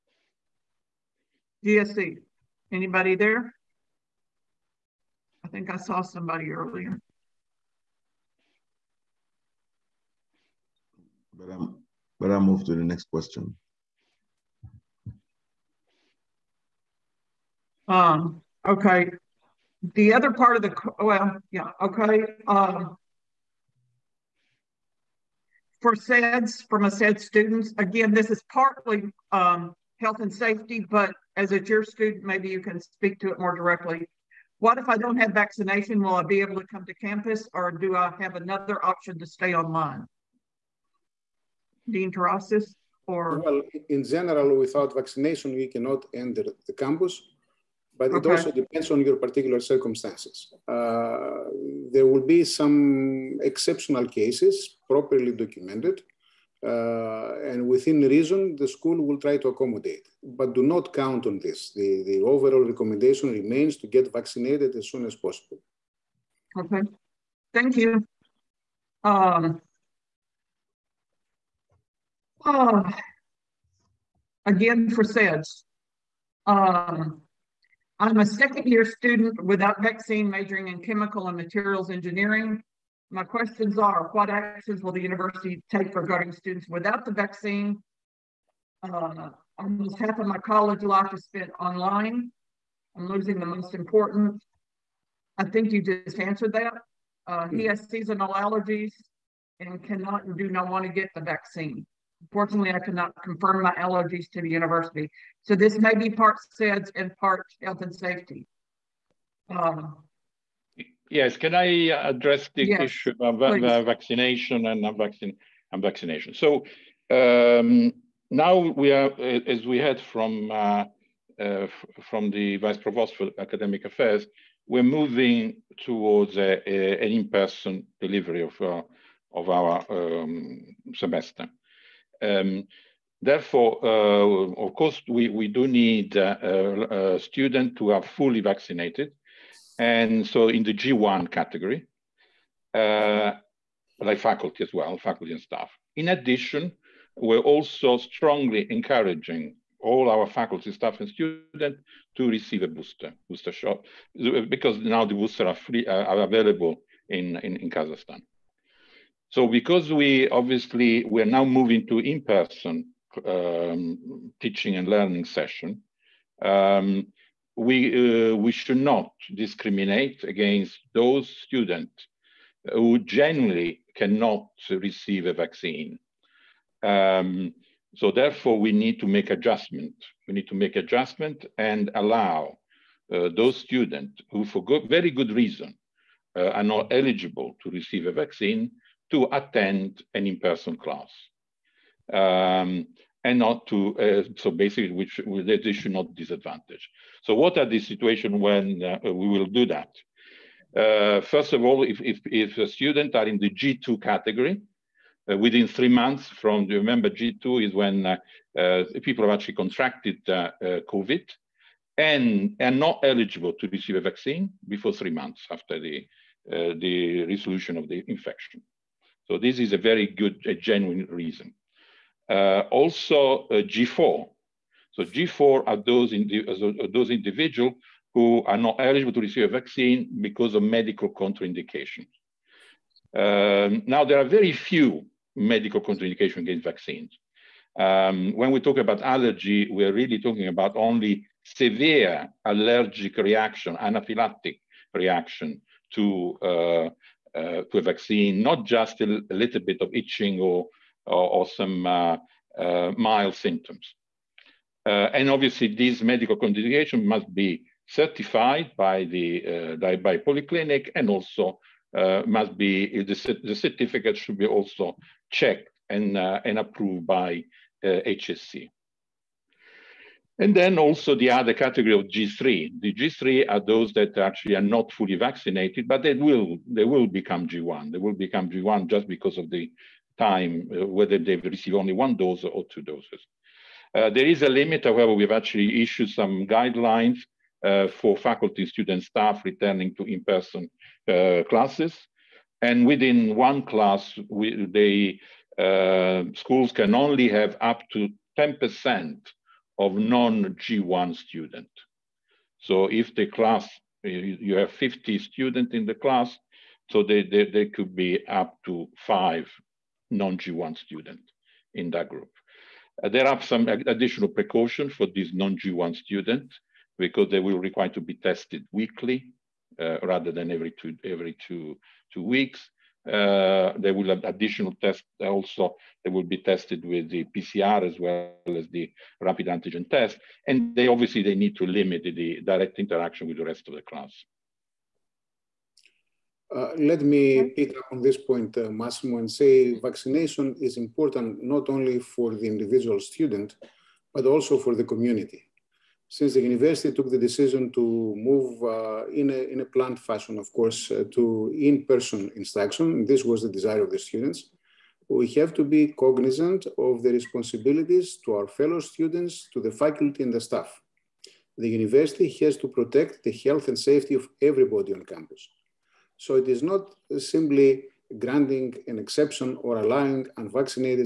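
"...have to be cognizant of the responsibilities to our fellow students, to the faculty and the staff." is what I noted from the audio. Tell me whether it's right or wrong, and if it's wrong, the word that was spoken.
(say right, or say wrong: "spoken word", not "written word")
right.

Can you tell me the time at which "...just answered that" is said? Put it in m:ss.
1:35.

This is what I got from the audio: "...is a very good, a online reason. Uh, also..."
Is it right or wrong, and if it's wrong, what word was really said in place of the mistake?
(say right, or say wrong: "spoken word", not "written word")
wrong: "genuine", not "online".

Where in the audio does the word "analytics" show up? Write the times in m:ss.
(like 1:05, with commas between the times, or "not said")
not said.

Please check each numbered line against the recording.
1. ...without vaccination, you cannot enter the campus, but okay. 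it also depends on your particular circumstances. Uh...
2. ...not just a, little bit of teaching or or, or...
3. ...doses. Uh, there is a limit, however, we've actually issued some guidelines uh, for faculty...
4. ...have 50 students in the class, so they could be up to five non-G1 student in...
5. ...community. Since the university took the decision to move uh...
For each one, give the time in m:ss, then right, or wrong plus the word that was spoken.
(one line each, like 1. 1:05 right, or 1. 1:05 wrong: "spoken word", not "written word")
1. 0:44 right
2. 4:08 wrong: "itching", not "teaching"
3. 4:42 right
4. 5:04 right
5. 5:44 right.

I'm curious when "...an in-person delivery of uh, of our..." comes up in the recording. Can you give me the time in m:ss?
2:07.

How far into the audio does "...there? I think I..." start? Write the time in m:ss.
0:03.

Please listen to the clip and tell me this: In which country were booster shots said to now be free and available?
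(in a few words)
Kazakhstan.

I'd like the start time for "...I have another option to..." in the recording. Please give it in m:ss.
0:37.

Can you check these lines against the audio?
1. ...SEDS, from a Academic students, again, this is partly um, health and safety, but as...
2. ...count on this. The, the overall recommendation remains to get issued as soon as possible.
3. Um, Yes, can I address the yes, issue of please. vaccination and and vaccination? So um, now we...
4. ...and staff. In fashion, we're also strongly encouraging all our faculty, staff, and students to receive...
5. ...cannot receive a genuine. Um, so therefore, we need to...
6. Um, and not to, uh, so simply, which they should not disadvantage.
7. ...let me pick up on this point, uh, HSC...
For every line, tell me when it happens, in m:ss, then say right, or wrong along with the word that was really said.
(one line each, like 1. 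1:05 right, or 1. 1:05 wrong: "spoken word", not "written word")
1. 0:25 wrong: "SED", not "Academic"
2. 1:00 wrong: "vaccinated", not "issued"
3. 1:49 right
4. 2:25 wrong: "addition", not "fashion"
5. 2:53 wrong: "vaccine", not "genuine"
6. 3:12 wrong: "basically", not "simply"
7. 5:36 wrong: "Massimo", not "HSC".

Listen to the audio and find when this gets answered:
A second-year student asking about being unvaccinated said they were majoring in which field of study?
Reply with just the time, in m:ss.
1:20.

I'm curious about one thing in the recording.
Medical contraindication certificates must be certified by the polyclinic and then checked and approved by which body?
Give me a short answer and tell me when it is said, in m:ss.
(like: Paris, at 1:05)
HSC, at 4:27.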